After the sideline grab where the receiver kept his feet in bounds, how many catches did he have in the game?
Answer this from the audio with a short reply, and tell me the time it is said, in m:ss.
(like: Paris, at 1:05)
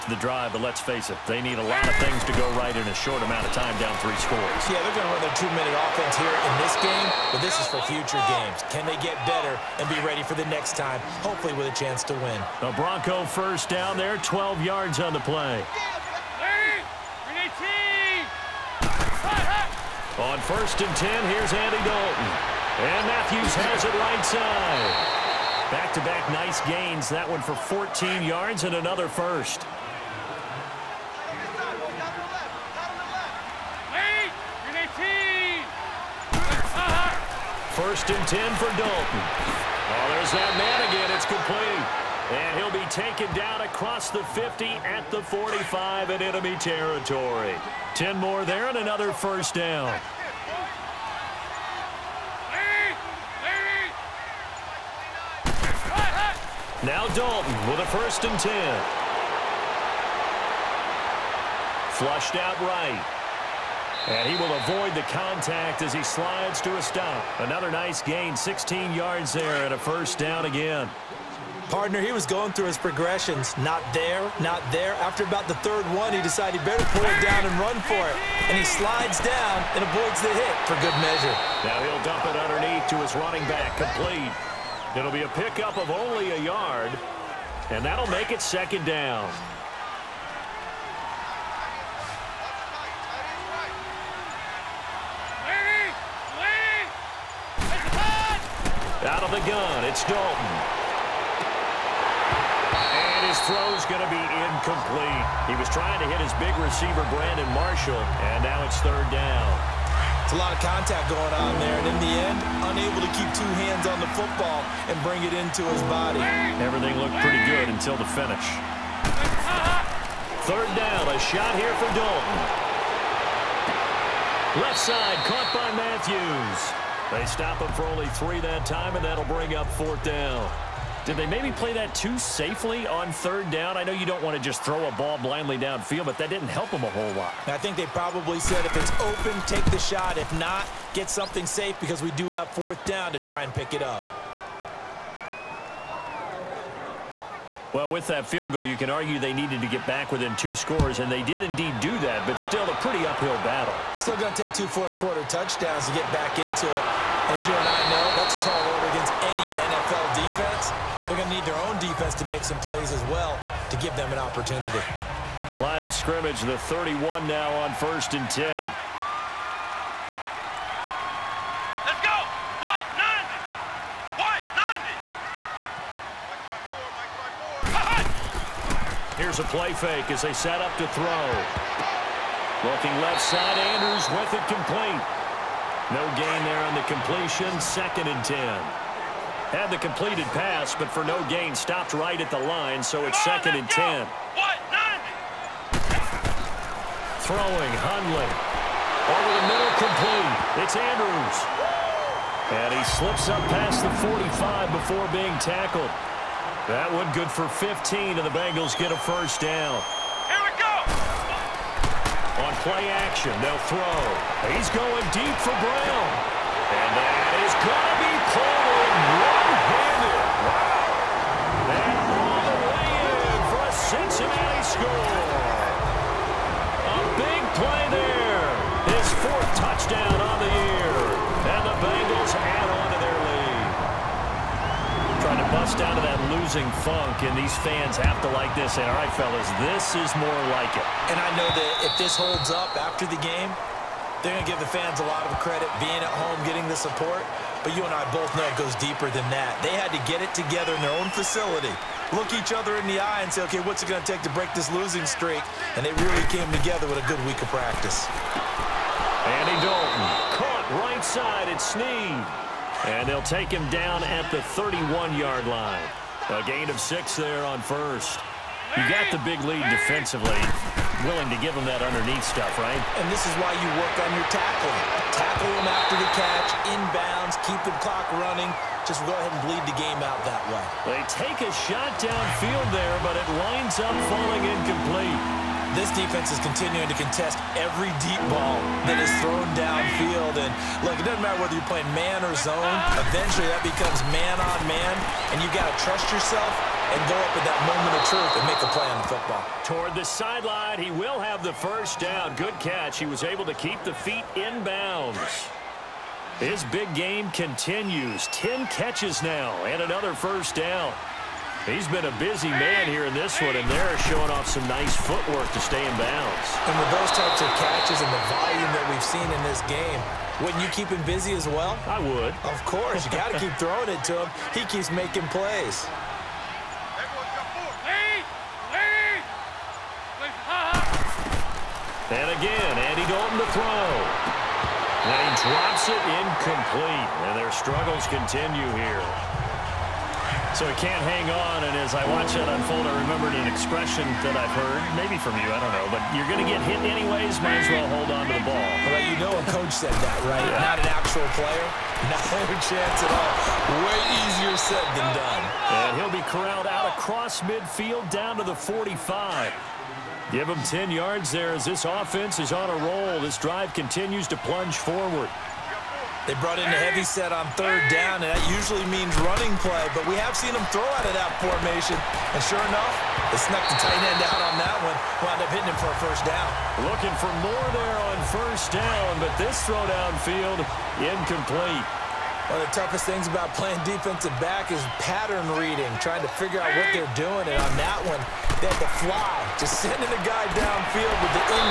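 10, at 5:08.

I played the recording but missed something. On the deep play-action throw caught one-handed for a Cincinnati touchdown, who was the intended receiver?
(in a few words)
Brown.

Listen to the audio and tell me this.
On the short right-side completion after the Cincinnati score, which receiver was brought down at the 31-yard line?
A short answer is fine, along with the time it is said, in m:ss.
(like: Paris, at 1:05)
Snead, at 4:21.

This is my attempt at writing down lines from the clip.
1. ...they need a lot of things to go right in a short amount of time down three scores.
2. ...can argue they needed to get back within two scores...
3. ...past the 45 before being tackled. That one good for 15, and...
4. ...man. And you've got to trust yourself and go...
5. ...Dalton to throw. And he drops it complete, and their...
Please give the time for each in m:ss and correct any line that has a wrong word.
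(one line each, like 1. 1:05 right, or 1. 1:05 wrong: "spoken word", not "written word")
1. 0:01 right
2. 2:28 right
3. 3:23 right
4. 4:54 right
5. 5:33 wrong: "incomplete", not "complete".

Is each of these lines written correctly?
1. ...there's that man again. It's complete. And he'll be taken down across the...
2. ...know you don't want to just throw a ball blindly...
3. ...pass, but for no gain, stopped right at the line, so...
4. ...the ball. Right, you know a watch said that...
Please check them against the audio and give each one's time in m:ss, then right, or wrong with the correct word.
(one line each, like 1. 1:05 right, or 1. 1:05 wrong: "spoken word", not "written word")
1. 0:40 right
2. 2:13 right
3. 3:10 right
4. 5:48 wrong: "coach", not "watch".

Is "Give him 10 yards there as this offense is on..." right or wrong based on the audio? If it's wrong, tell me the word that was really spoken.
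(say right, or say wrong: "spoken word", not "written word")
right.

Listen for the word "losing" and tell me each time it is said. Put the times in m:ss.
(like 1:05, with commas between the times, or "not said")
3:56, 4:14.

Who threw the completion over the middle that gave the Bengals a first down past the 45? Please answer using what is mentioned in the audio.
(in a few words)
Hundley.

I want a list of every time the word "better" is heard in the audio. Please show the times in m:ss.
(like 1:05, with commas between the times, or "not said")
0:09, 1:16.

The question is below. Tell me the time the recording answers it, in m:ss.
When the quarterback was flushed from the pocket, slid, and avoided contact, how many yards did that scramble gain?
1:08.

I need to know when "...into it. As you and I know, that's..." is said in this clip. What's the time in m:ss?
2:36.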